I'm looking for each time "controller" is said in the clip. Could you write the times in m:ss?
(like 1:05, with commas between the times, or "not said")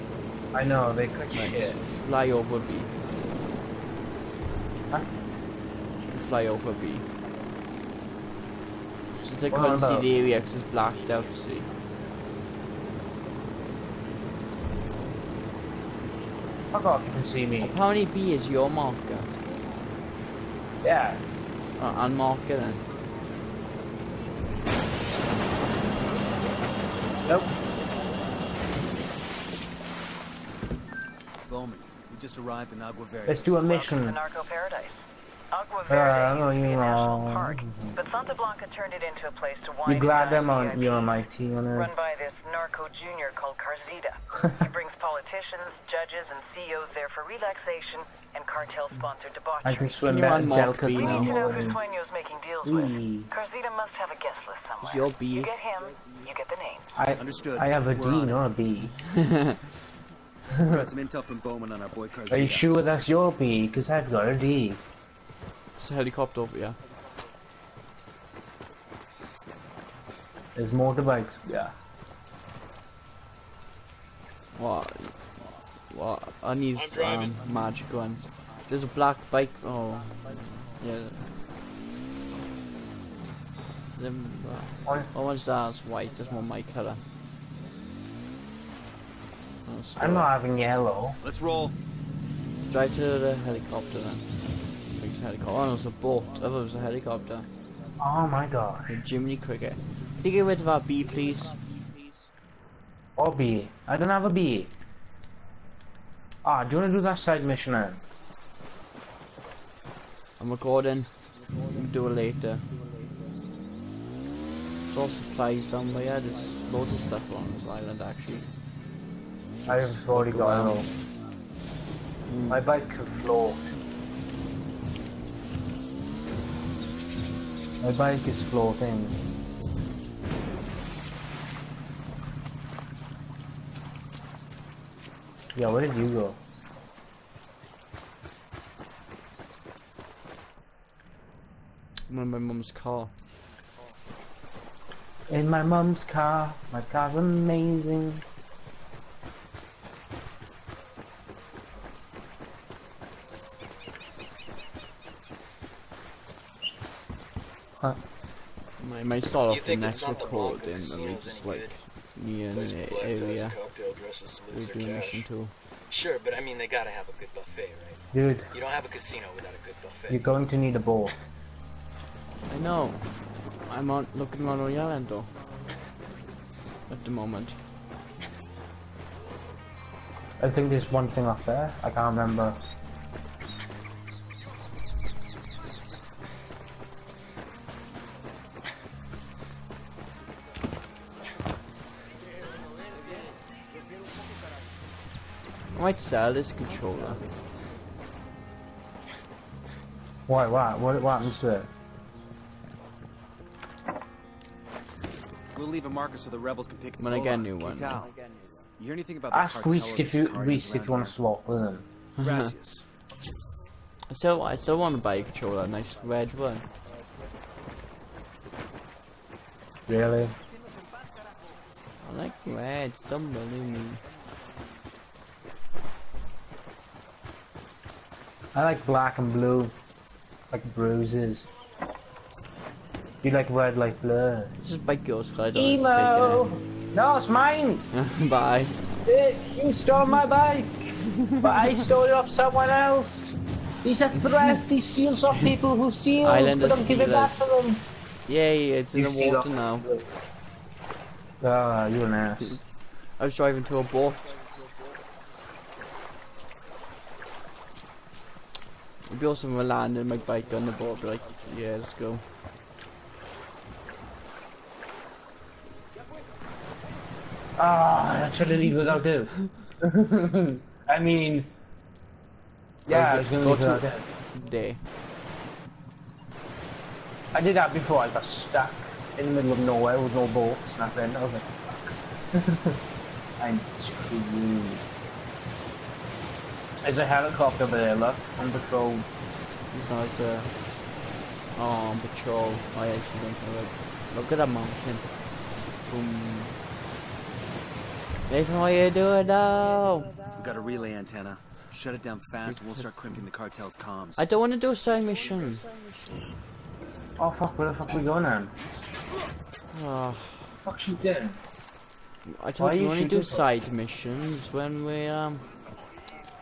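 3:16, 3:35.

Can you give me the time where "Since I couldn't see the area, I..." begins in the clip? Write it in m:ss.
0:09.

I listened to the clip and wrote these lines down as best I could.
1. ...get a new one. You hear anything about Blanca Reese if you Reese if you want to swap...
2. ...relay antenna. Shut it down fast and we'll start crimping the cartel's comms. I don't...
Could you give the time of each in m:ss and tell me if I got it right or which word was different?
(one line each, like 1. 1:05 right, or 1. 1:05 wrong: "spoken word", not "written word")
1. 3:27 wrong: "Ask", not "Blanca"
2. 5:00 right.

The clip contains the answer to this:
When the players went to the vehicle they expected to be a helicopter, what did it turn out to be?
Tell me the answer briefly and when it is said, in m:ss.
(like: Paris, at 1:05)
A boat, at 1:35.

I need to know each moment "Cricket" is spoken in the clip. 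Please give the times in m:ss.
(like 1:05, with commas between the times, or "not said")
1:39.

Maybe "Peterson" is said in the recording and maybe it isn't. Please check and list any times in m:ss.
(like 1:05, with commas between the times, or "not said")
not said.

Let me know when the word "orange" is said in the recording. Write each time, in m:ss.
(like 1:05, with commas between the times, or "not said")
1:25.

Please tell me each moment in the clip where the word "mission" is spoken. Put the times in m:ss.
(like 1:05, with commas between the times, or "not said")
0:33, 1:47, 2:44, 5:05, 5:13.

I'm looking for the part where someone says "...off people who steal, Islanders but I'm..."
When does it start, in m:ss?
4:05.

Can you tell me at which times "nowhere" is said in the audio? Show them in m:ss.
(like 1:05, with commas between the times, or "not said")
4:39.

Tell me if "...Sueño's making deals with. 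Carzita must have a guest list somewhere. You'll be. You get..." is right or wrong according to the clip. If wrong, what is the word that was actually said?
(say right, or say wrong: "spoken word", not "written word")
right.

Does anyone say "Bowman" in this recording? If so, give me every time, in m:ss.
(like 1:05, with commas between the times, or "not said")
0:31, 1:01.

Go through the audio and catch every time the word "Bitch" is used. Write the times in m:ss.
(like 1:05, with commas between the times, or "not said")
3:59.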